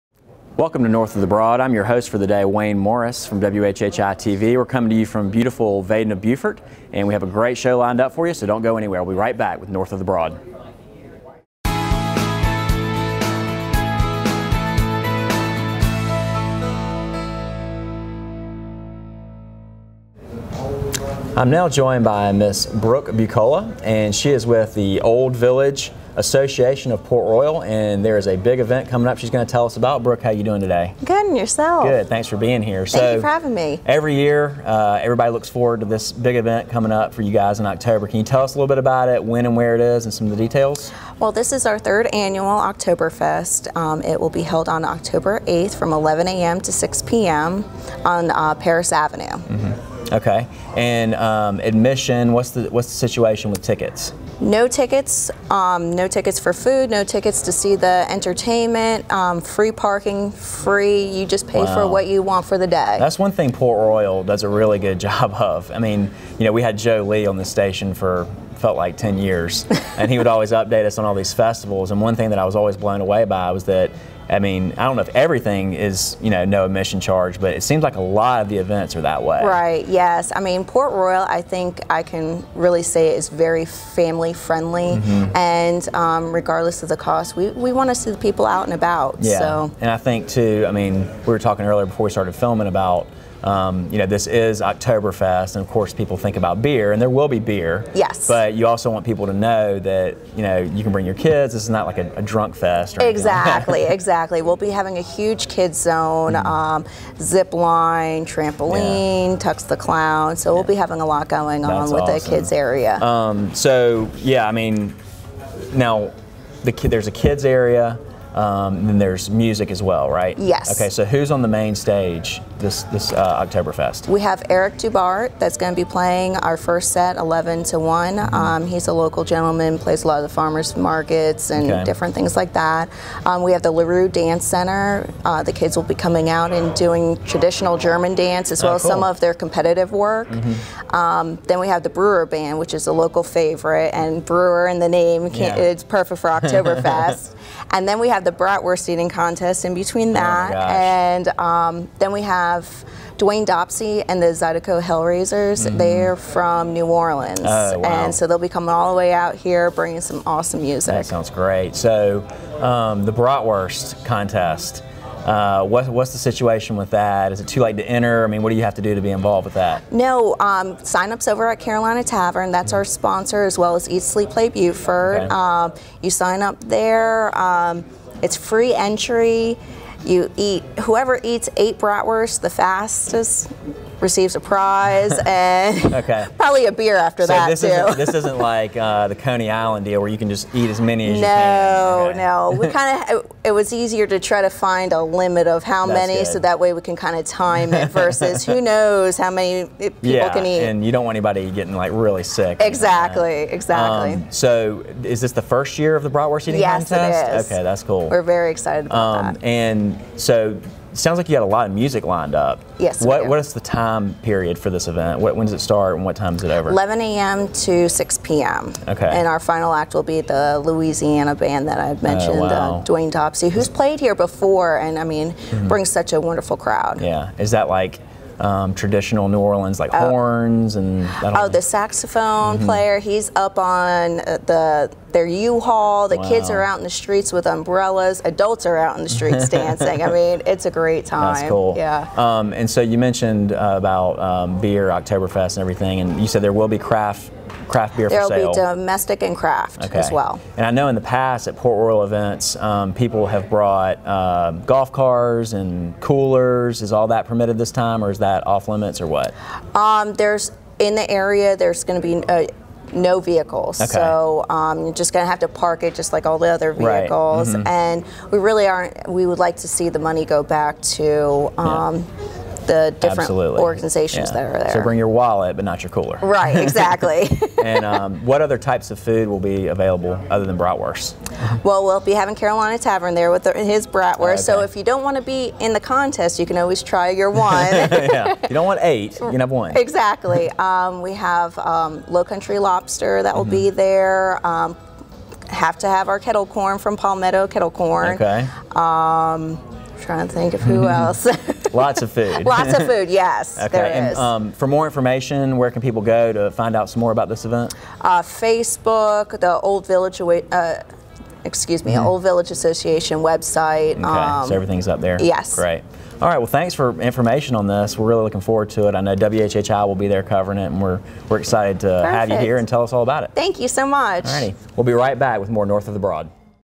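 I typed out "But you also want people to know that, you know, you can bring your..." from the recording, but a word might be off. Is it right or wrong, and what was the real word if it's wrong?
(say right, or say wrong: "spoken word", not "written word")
right.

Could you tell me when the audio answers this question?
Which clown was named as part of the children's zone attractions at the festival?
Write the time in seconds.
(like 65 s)
109 s.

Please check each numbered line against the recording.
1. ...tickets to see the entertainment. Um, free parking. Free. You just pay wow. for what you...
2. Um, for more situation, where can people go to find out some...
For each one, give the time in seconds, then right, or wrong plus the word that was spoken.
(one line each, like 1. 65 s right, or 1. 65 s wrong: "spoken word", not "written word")
1. 57 s right
2. 304 s wrong: "information", not "situation".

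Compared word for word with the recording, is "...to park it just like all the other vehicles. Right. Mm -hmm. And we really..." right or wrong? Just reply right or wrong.
right.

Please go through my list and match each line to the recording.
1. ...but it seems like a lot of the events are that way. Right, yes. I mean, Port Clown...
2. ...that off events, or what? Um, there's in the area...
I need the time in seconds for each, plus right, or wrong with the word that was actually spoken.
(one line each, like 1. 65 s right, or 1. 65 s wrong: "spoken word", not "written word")
1. 77 s wrong: "Royal", not "Clown"
2. 258 s wrong: "limits", not "events".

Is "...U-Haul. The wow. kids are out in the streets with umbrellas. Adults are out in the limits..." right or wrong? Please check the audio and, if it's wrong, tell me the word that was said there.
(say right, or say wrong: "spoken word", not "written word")
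wrong: "streets", not "limits".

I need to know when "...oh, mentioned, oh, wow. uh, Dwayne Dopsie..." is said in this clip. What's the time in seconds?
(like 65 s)
221 s.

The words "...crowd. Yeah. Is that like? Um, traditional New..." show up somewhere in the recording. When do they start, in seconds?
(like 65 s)
226 s.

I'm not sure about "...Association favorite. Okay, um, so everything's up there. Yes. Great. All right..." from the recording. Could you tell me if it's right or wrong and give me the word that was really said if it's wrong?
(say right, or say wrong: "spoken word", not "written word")
wrong: "website", not "favorite".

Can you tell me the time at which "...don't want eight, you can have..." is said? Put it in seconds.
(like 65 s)
288 s.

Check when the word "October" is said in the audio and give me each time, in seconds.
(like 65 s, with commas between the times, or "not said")
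37 s, 44 s.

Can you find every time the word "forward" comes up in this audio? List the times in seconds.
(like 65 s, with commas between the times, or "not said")
35 s, 318 s.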